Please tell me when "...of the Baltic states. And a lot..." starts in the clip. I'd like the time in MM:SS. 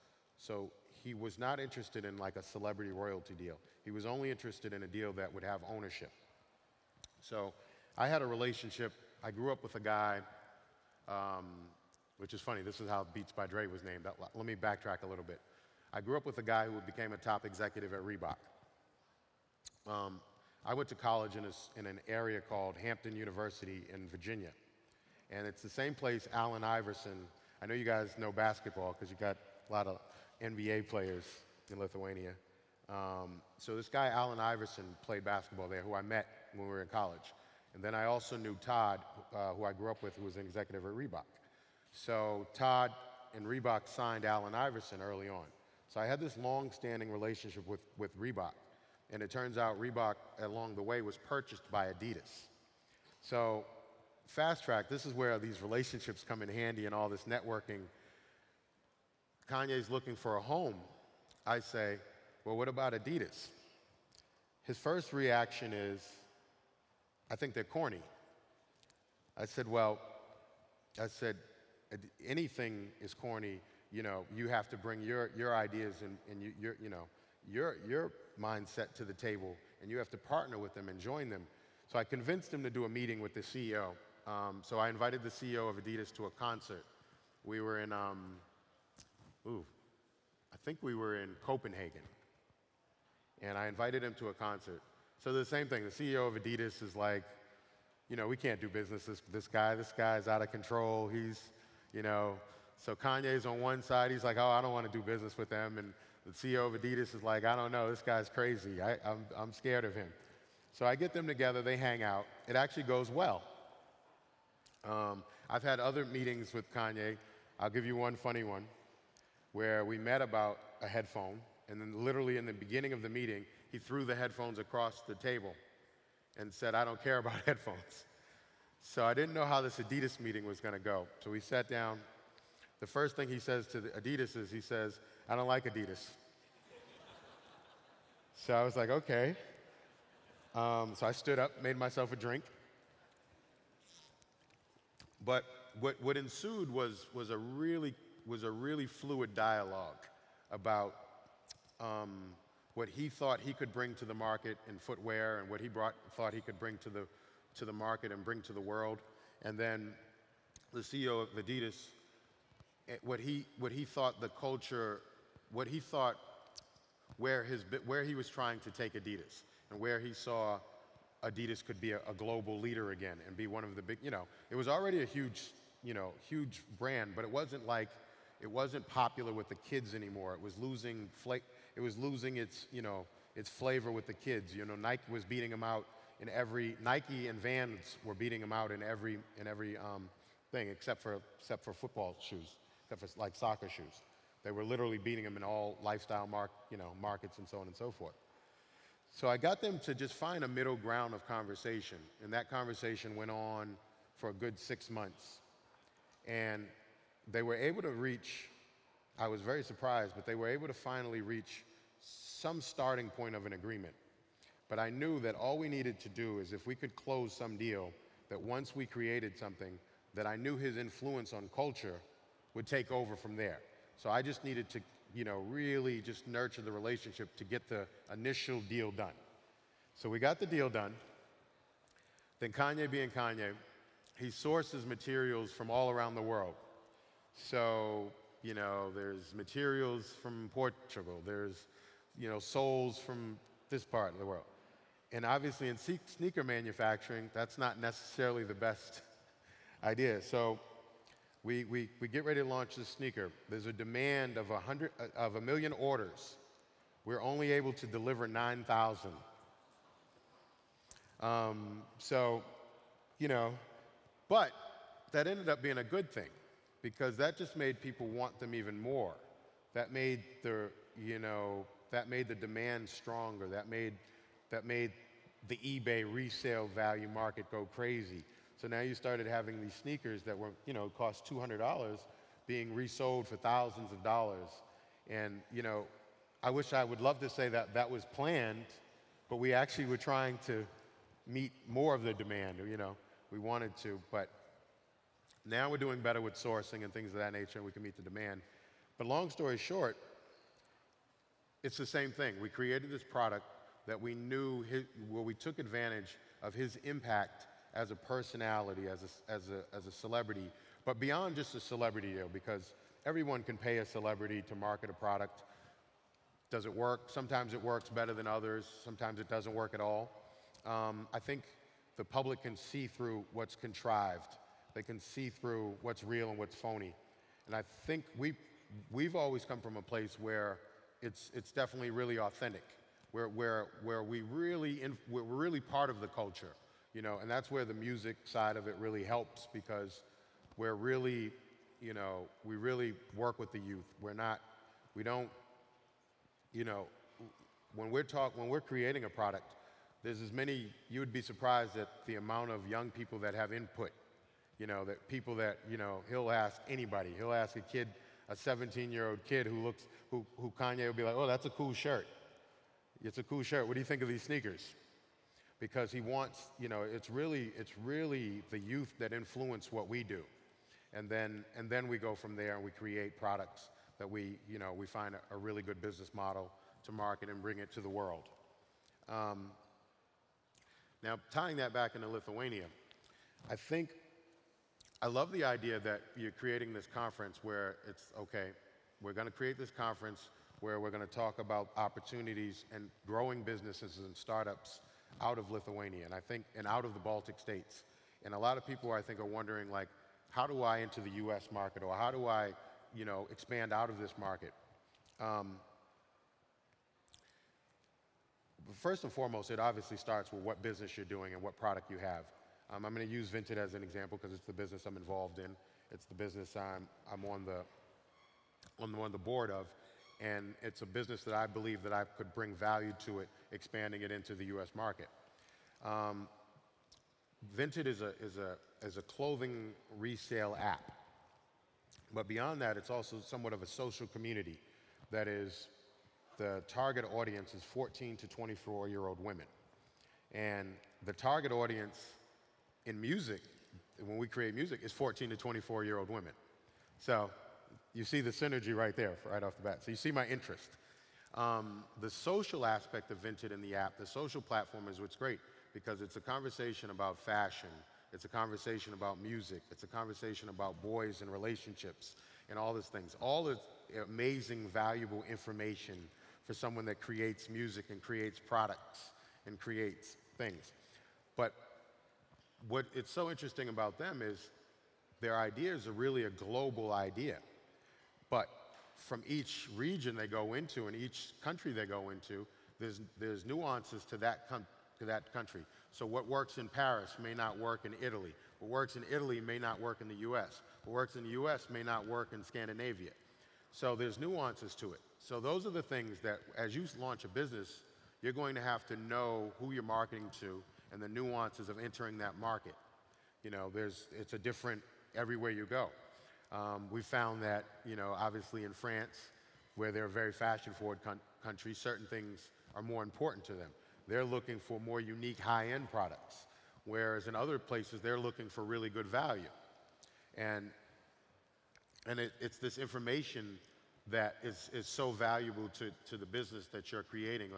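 06:36.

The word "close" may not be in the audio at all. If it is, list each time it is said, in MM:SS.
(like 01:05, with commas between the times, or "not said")
03:36.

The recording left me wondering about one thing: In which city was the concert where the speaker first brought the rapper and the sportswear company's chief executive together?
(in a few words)
Copenhagen.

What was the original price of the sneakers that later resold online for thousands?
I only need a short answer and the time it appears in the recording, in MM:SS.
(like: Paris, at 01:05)
$200, at 04:41.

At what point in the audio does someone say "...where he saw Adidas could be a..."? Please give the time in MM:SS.
02:49.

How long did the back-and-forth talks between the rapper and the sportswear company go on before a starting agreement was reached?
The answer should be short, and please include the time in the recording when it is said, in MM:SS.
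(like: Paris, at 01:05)
6 months, at 03:24.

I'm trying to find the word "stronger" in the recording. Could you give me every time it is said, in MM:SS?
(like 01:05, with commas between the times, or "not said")
04:32.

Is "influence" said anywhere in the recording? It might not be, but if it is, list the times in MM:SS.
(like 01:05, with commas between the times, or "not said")
03:40, 06:09.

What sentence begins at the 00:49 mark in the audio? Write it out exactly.
And it turns out Reebok, along the way, was purchased by Adidas.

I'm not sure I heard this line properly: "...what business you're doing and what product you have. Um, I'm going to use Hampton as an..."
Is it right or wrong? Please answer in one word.
wrong.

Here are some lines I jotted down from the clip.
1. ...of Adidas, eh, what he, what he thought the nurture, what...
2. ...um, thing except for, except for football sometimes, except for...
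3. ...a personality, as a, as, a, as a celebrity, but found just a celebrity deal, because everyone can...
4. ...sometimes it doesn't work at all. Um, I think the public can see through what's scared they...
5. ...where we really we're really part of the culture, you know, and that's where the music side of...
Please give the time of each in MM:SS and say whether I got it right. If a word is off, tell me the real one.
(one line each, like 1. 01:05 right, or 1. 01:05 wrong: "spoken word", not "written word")
1. 02:41 wrong: "culture", not "nurture"
2. 03:09 wrong: "shoes", not "sometimes"
3. 05:07 wrong: "beyond", not "found"
4. 05:18 wrong: "contrived", not "scared"
5. 05:33 right.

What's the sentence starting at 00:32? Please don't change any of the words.
Um, so this guy, Allen Iverson, played basketball there, who I met when we were in college.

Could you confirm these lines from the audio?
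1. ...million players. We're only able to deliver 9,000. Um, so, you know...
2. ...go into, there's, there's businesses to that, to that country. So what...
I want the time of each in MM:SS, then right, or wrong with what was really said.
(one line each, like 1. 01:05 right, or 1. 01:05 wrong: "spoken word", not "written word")
1. 04:15 wrong: "orders", not "players"
2. 08:01 wrong: "nuances", not "businesses".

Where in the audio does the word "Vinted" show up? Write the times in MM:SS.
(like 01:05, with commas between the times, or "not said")
06:53, 07:07, 07:33.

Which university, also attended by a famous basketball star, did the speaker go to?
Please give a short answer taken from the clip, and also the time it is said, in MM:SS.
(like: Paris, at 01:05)
Hampton University, at 00:22.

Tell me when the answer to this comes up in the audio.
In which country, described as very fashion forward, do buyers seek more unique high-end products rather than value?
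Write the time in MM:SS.
08:28.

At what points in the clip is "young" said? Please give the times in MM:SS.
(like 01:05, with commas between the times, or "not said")
05:52.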